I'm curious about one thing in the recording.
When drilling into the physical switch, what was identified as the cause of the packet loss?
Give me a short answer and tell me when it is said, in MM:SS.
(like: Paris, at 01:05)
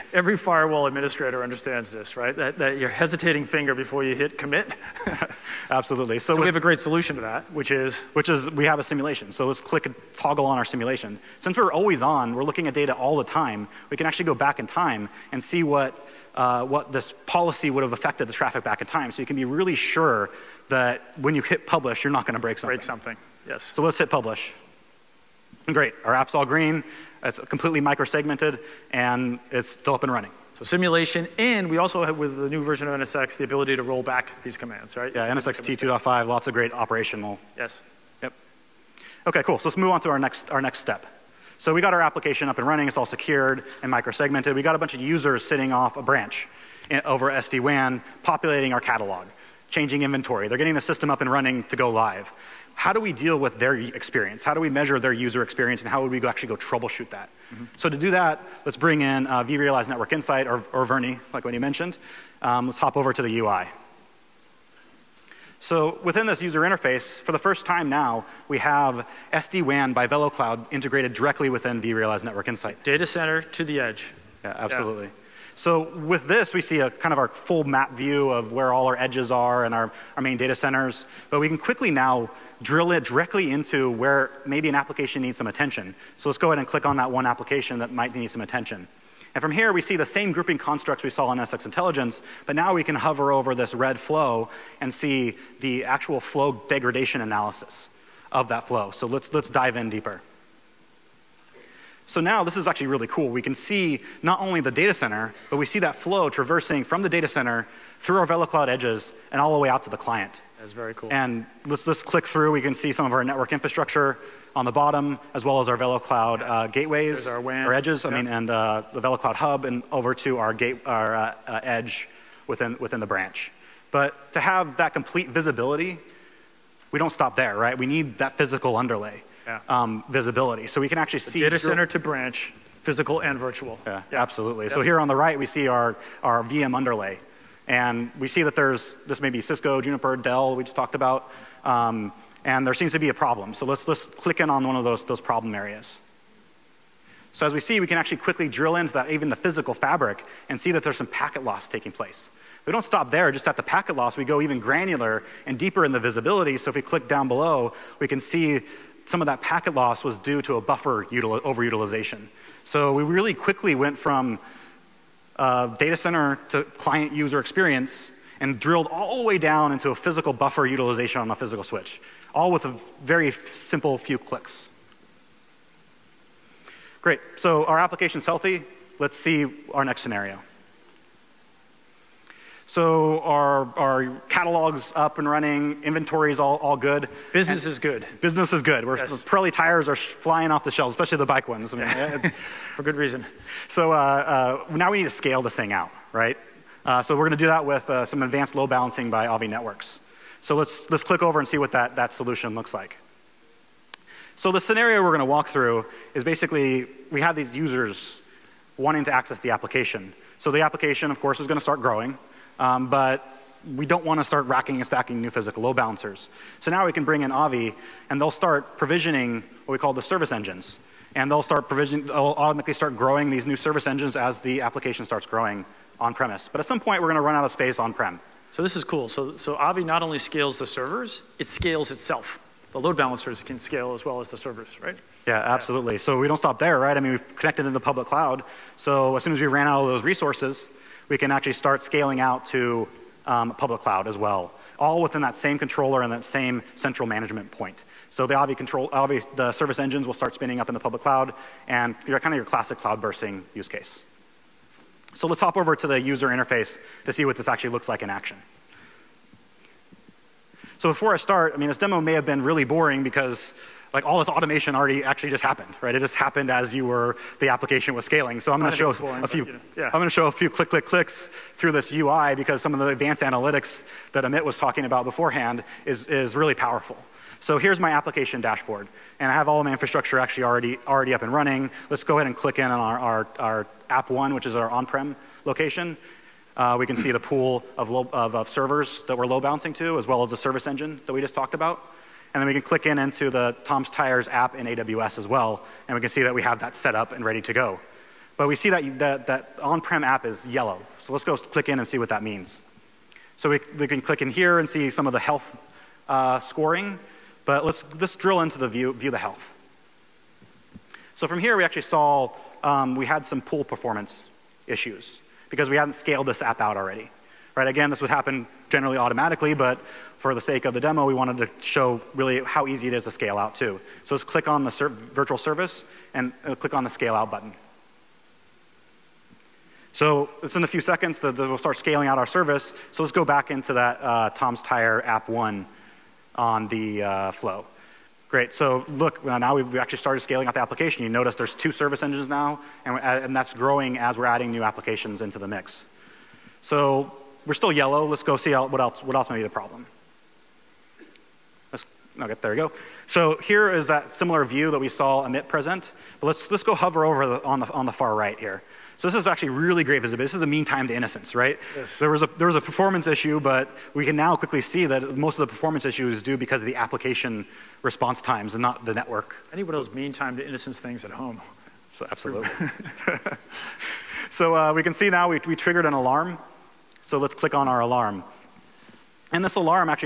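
Buffer overutilization, at 02:40.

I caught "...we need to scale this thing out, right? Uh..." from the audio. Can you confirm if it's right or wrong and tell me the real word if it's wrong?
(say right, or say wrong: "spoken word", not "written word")
right.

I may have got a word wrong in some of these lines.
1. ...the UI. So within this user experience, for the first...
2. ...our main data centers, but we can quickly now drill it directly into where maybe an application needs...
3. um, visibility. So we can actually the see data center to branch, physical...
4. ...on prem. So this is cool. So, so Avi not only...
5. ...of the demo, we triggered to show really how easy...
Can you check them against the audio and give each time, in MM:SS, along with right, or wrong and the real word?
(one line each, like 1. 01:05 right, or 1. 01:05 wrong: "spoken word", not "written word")
1. 01:03 wrong: "interface", not "experience"
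2. 01:20 right
3. 02:09 right
4. 03:47 right
5. 05:20 wrong: "wanted", not "triggered".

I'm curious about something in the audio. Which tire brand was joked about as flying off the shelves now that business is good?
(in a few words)
Pirelli.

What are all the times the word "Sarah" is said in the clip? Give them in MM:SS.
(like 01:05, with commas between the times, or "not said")
not said.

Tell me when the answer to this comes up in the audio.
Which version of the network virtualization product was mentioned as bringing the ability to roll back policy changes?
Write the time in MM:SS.
00:35.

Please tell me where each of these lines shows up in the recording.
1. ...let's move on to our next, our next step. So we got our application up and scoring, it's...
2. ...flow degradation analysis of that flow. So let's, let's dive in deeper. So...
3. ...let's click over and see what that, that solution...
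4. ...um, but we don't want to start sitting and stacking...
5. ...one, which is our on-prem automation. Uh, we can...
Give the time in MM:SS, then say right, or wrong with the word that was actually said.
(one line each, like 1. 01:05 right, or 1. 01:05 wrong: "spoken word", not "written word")
1. 00:39 wrong: "running", not "scoring"
2. 01:36 right
3. 03:20 right
4. 03:32 wrong: "racking", not "sitting"
5. 04:44 wrong: "location", not "automation".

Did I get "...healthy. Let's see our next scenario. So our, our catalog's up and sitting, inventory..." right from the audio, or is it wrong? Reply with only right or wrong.
wrong.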